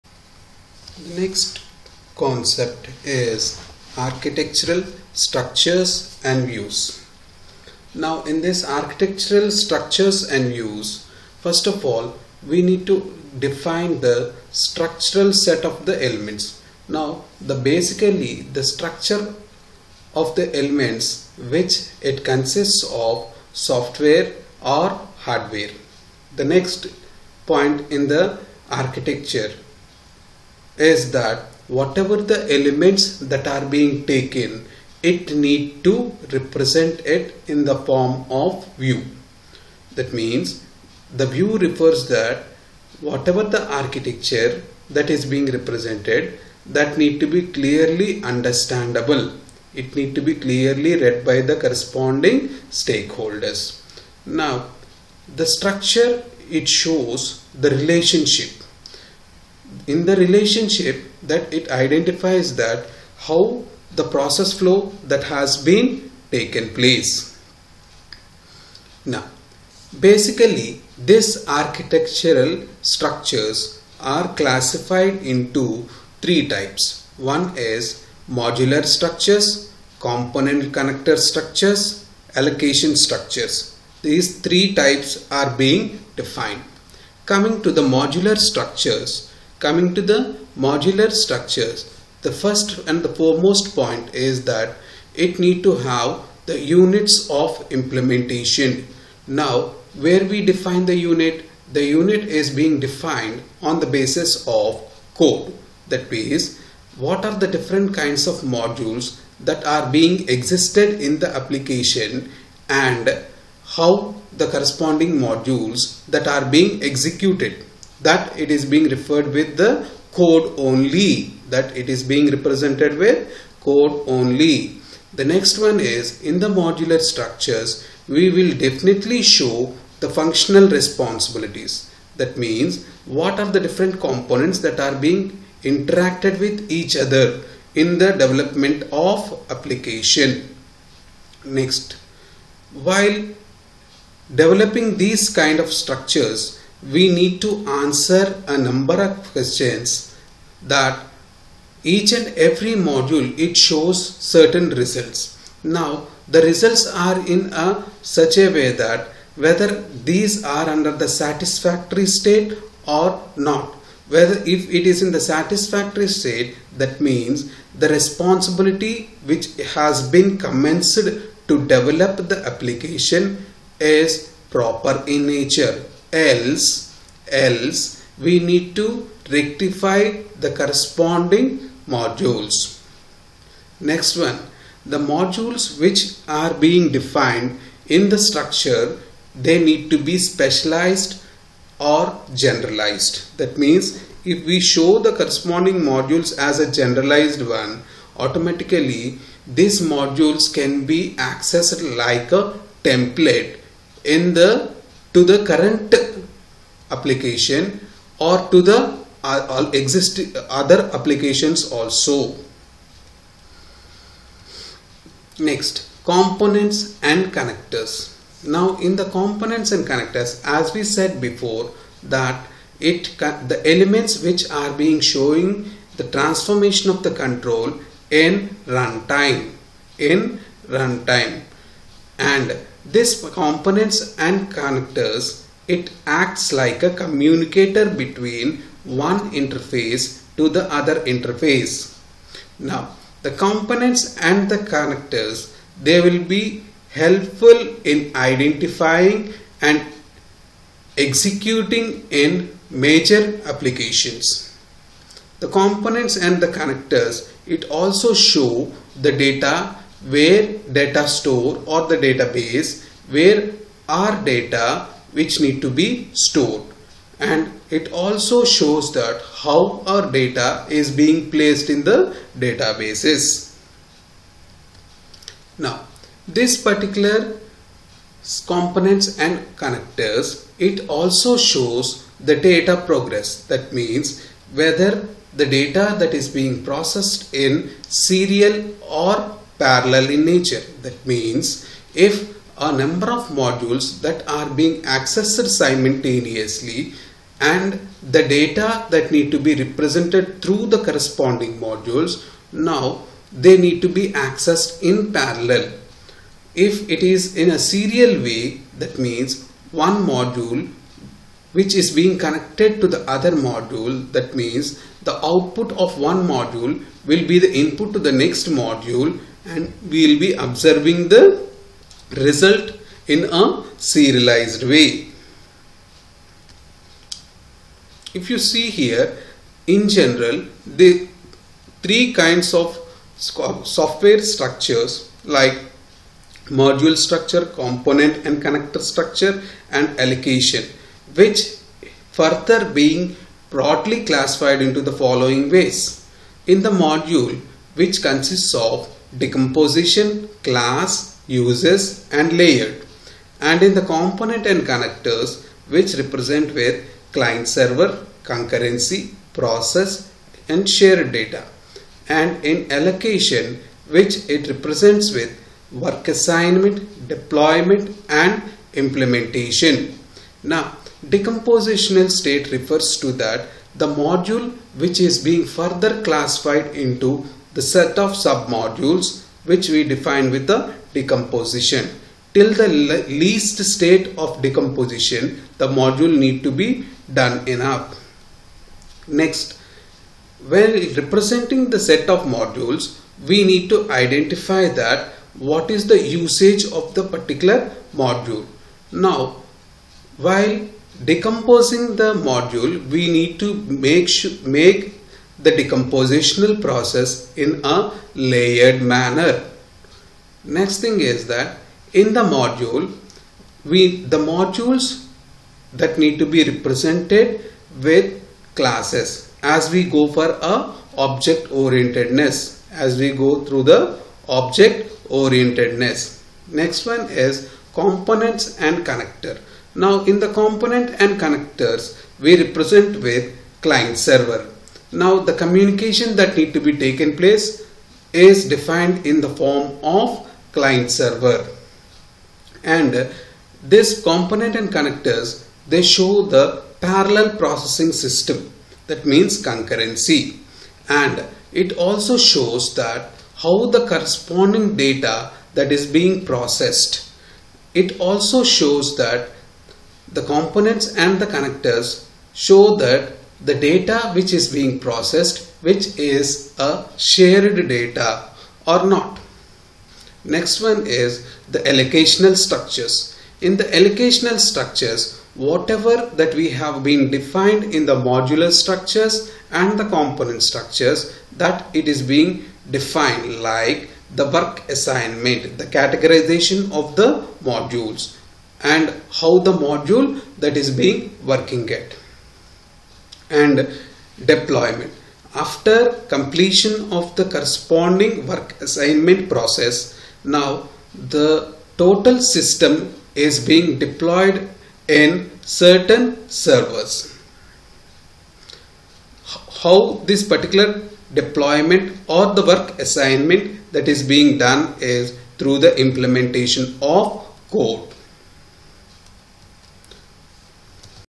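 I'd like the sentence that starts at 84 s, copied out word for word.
These three types are being defined.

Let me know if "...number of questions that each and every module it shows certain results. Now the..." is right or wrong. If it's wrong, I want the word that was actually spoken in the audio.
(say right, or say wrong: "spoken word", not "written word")
right.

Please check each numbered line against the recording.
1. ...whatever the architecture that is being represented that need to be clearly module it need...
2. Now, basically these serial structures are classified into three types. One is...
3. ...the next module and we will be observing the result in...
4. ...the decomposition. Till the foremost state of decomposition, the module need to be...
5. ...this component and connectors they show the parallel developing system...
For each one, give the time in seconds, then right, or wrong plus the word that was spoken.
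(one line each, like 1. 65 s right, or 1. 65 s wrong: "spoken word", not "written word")
1. 43 s wrong: "understandable", not "module"
2. 69 s wrong: "architectural", not "serial"
3. 318 s right
4. 380 s wrong: "least", not "foremost"
5. 443 s wrong: "processing", not "developing".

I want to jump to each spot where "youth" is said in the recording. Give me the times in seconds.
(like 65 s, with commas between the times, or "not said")
not said.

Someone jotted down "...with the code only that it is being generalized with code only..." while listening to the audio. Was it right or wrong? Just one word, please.
wrong.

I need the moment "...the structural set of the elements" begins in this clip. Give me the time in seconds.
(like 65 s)
14 s.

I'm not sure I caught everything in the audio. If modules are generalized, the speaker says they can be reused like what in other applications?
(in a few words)
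a template.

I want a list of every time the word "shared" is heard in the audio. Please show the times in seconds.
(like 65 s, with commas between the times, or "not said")
360 s, 466 s.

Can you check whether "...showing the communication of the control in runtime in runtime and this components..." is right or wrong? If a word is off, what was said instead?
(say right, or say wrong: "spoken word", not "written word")
wrong: "transformation", not "communication".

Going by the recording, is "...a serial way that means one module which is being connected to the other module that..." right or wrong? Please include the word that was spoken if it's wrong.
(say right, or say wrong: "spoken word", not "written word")
right.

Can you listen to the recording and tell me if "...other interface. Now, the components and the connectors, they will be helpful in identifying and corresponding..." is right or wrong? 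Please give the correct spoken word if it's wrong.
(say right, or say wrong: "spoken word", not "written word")
wrong: "executing", not "corresponding".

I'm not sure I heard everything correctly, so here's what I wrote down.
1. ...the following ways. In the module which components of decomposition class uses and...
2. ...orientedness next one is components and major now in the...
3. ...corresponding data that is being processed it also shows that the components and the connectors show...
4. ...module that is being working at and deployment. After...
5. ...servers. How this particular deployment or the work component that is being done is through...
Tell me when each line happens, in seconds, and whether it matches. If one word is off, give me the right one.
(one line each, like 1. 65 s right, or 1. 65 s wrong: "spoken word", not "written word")
1. 344 s wrong: "consists", not "components"
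2. 425 s wrong: "connector", not "major"
3. 453 s right
4. 489 s right
5. 506 s wrong: "assignment", not "component".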